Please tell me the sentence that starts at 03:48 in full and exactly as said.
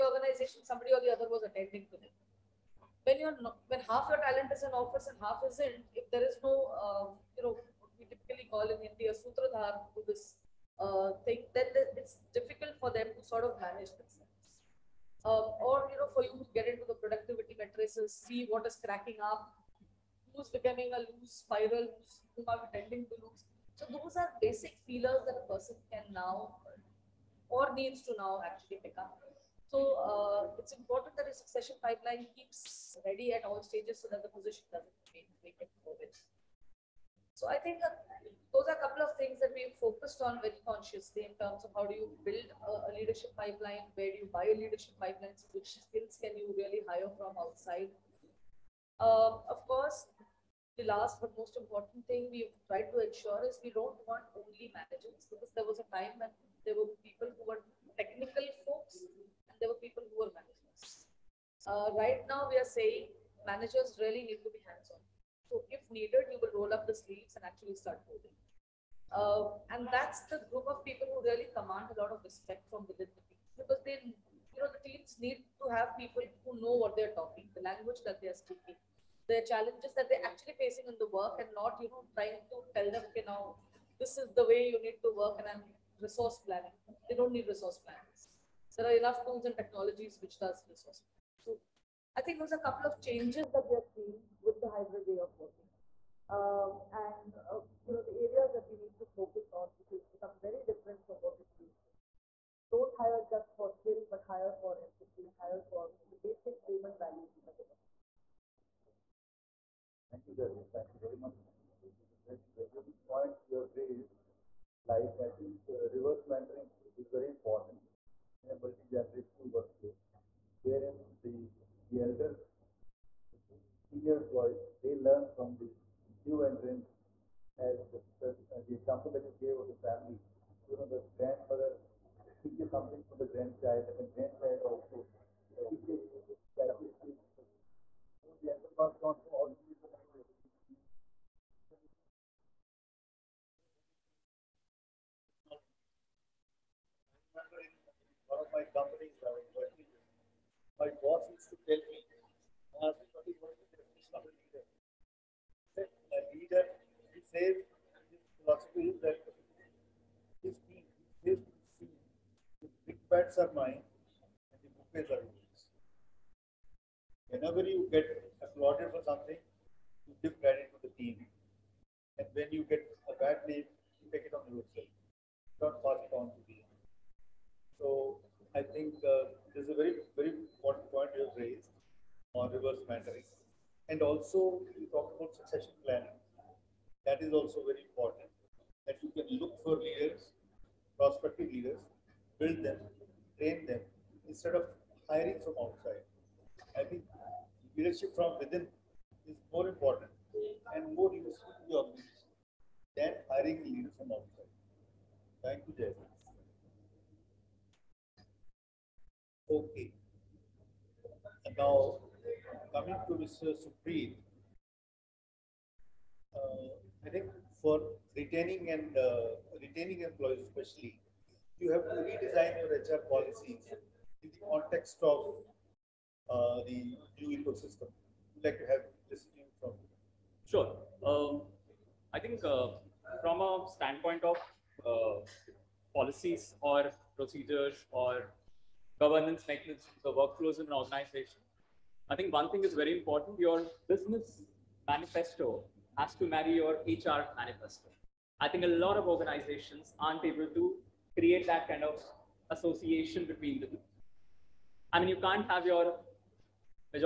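Would like to have this from?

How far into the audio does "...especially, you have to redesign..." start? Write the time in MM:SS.
03:40.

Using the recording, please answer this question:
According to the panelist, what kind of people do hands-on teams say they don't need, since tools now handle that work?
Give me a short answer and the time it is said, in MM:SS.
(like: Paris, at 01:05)
resource planners, at 01:27.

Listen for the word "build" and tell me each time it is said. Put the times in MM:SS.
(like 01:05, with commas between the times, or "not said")
00:42, 03:12.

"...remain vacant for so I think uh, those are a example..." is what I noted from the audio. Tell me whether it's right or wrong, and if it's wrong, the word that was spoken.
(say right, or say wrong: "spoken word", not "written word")
wrong: "couple", not "example".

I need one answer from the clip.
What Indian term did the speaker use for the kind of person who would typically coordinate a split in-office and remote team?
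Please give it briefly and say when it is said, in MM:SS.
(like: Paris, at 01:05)
Sutradhar, at 00:09.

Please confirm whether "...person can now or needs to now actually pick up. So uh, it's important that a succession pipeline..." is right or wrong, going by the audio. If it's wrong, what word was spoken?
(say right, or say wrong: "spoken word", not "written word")
right.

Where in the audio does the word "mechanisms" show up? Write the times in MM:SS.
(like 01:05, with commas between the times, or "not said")
03:59.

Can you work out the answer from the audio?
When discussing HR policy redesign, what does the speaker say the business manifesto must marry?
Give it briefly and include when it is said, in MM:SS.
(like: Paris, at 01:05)
HR manifesto, at 04:06.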